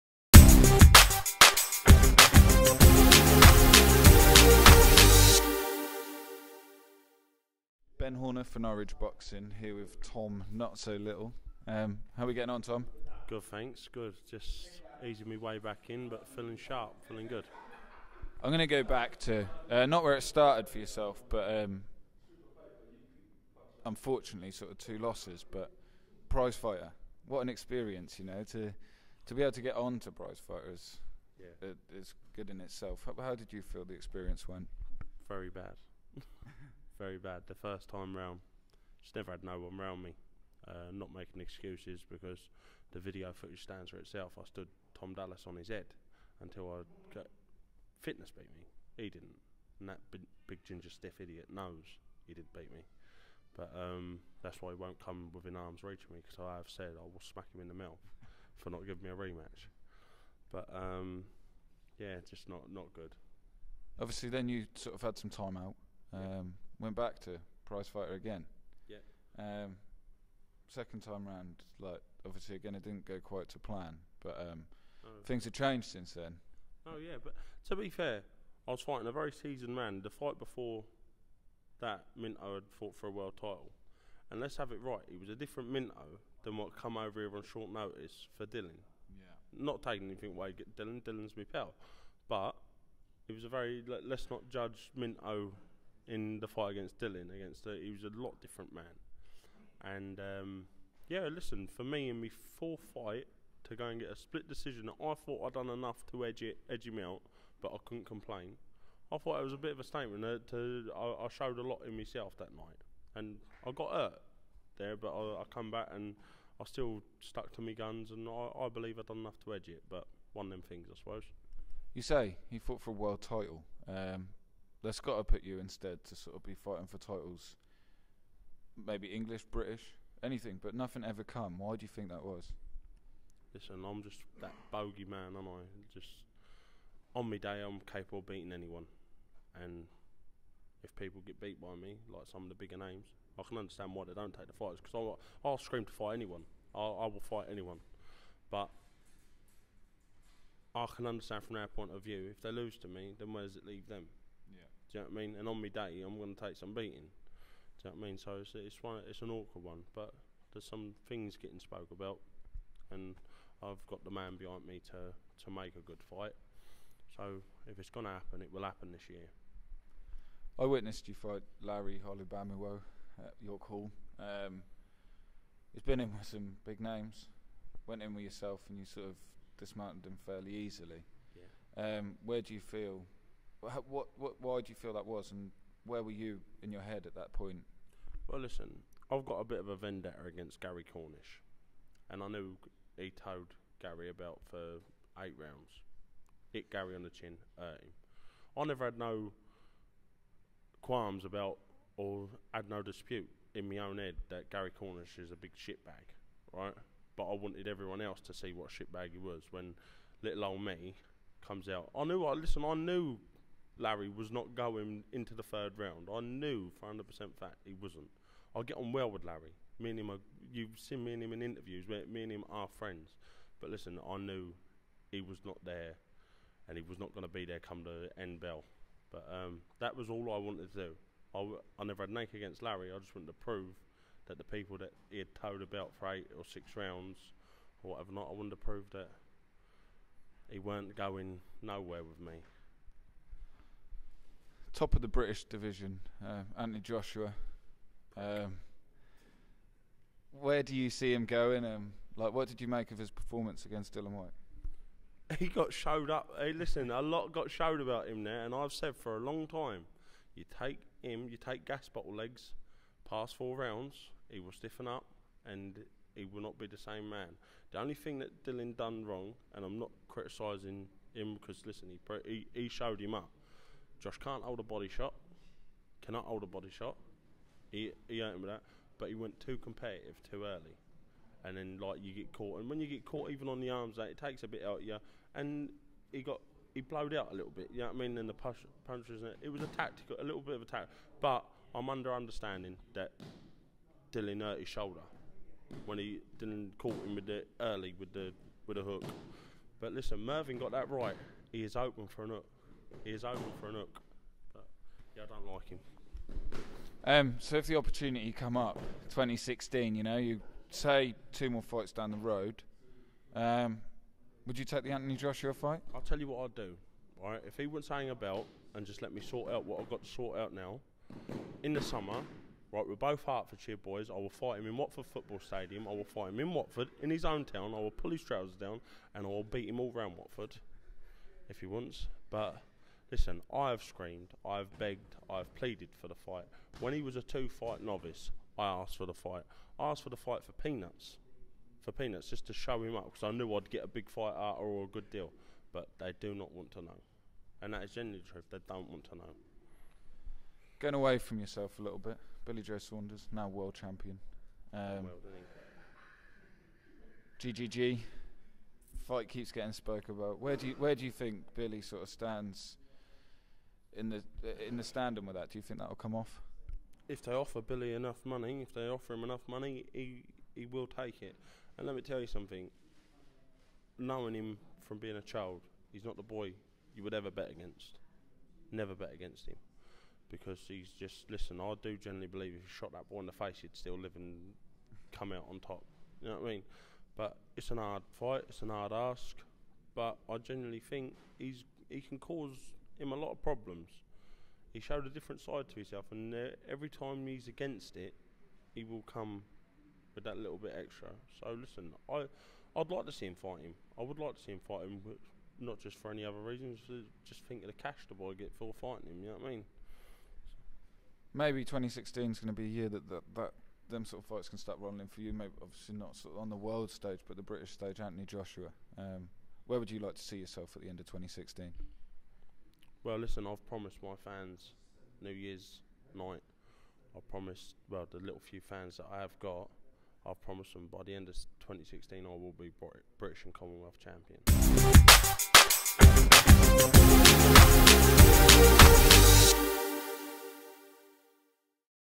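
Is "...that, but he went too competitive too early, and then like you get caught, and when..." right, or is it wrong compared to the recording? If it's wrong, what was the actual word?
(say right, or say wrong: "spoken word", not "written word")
right.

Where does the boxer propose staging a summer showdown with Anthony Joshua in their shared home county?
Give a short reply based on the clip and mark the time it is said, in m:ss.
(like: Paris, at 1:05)
Watford Football Stadium, at 5:24.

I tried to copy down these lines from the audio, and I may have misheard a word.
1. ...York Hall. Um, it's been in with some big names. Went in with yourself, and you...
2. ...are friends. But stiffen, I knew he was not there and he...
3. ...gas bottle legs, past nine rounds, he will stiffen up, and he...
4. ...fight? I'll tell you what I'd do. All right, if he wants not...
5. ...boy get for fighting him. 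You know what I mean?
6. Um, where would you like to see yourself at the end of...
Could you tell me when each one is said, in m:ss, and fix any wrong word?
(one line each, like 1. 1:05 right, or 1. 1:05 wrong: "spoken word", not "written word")
1. 2:53 right
2. 3:42 wrong: "listen", not "stiffen"
3. 4:21 wrong: "four", not "nine"
4. 5:15 right
5. 6:48 right
6. 6:58 right.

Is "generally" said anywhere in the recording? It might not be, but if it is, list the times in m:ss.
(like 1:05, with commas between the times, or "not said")
5:47, 6:21.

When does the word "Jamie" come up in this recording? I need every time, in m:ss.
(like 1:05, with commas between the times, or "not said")
not said.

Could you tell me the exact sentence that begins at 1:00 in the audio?
But um, yeah, just not not good.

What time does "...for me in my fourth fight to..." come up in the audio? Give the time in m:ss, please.
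1:41.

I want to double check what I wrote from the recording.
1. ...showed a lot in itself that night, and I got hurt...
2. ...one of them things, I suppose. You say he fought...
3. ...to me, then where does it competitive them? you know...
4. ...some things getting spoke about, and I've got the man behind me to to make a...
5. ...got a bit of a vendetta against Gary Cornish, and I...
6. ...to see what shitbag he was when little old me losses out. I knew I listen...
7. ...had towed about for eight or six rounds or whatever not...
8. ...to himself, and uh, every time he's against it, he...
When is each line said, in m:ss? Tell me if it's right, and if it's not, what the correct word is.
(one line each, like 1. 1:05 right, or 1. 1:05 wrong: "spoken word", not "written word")
1. 1:51 wrong: "myself", not "itself"
2. 2:00 right
3. 2:32 wrong: "leave", not "competitive"
4. 2:40 right
5. 3:09 right
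6. 3:28 wrong: "comes", not "losses"
7. 3:55 right
8. 6:35 right.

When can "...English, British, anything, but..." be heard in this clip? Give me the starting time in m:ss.
2:09.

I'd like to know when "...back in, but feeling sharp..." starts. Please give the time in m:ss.
0:15.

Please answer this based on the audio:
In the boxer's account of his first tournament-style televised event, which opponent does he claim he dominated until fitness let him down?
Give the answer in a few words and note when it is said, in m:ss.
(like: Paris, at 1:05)
Tom Dallas, at 0:44.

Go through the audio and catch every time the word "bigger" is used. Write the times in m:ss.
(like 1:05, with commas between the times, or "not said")
2:22.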